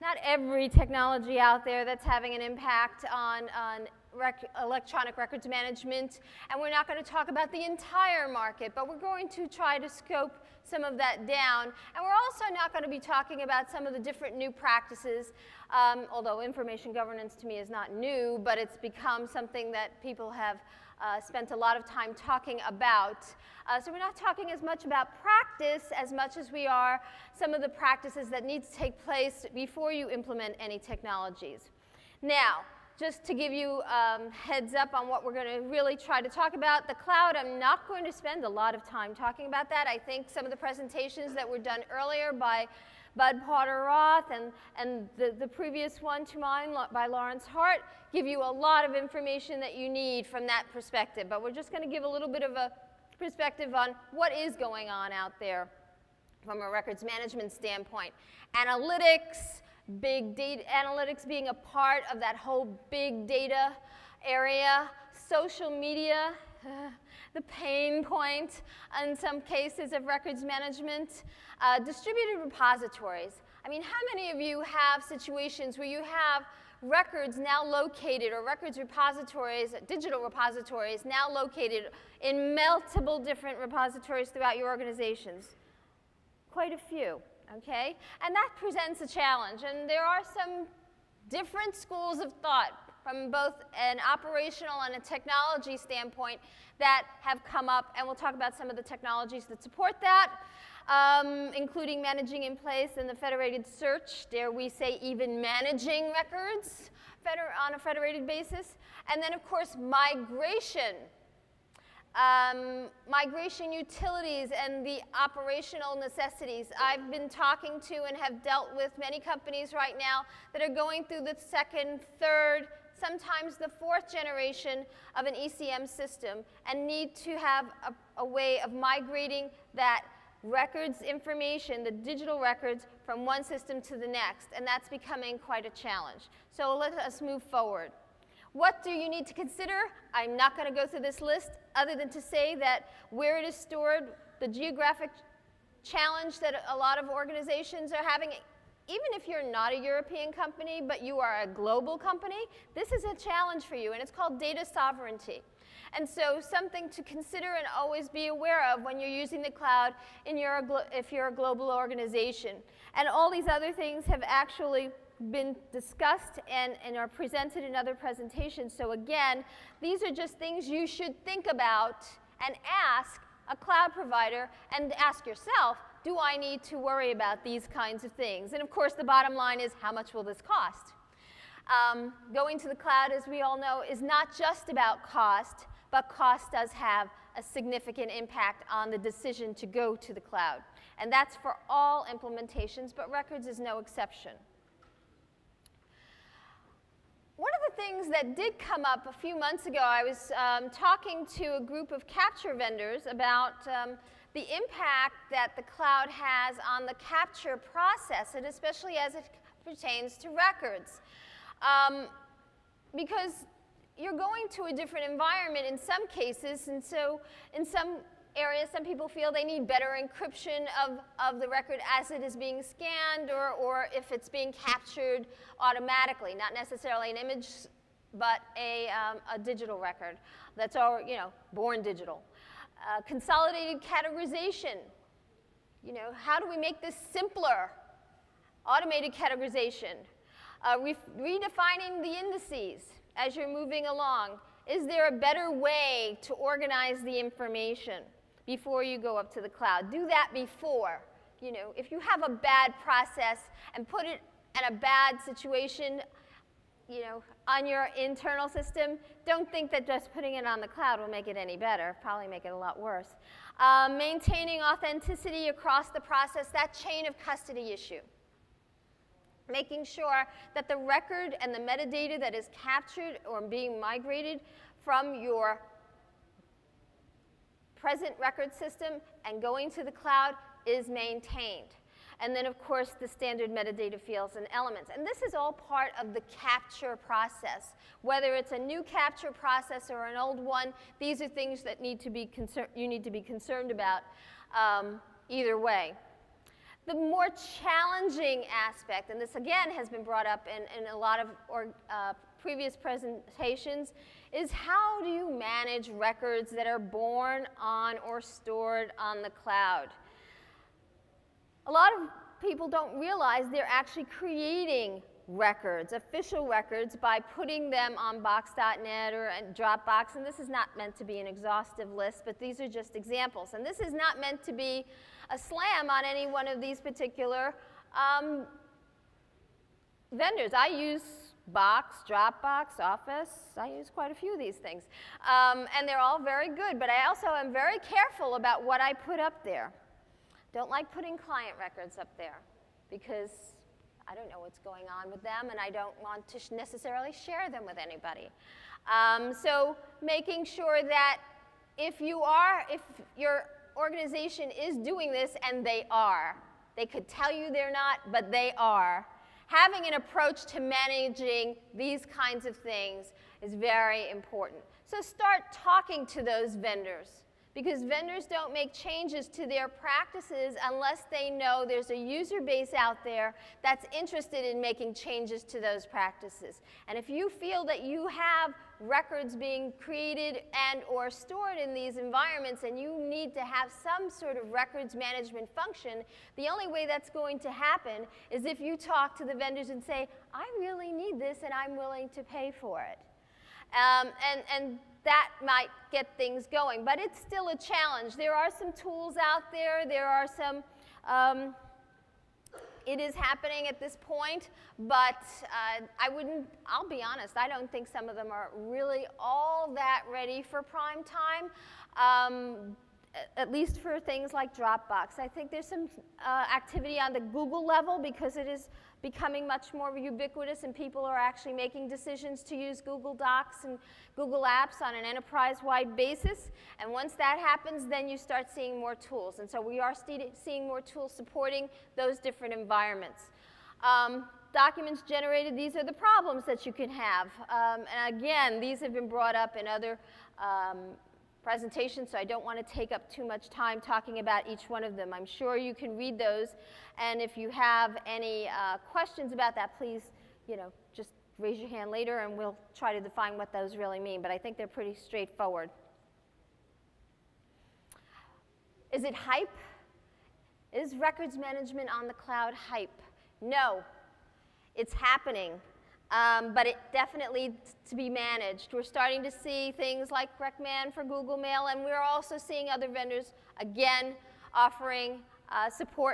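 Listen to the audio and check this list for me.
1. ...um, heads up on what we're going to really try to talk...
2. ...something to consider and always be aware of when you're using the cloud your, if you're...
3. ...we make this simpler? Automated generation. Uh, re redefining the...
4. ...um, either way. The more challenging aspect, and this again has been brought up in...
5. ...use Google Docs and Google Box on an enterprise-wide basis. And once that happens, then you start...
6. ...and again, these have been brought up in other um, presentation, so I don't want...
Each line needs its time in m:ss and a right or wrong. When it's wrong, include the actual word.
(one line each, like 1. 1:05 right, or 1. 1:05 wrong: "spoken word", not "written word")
1. 0:33 right
2. 2:36 right
3. 3:56 wrong: "categorization", not "generation"
4. 4:54 right
5. 7:02 wrong: "Apps", not "Box"
6. 7:17 right.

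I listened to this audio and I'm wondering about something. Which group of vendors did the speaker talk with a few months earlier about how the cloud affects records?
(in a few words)
capture vendors.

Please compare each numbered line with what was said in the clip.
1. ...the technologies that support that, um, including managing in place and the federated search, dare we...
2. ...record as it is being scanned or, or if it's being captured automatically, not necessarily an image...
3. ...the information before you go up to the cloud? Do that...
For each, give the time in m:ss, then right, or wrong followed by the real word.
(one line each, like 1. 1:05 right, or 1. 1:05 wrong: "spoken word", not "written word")
1. 1:38 right
2. 3:41 right
3. 4:07 right.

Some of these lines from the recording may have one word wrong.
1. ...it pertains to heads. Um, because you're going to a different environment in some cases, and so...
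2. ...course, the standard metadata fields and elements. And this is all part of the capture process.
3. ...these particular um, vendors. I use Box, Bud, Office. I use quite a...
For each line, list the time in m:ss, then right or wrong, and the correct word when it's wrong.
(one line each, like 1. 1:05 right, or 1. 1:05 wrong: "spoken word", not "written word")
1. 3:29 wrong: "records", not "heads"
2. 4:42 right
3. 5:26 wrong: "Dropbox", not "Bud".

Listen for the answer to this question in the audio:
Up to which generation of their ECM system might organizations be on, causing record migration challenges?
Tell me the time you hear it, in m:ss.
2:03.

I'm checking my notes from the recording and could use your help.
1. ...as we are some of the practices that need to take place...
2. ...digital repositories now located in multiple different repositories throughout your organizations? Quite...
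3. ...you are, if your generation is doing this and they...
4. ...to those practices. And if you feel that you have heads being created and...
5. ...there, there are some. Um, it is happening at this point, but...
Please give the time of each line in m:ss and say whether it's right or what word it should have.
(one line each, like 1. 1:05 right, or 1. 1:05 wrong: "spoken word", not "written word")
1. 0:26 right
2. 1:19 right
3. 5:52 wrong: "organization", not "generation"
4. 6:15 wrong: "records", not "heads"
5. 6:39 right.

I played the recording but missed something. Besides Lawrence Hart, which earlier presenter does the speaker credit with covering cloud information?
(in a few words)
Bud Porter-Roth.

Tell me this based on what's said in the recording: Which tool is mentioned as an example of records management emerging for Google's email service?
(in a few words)
RecMan.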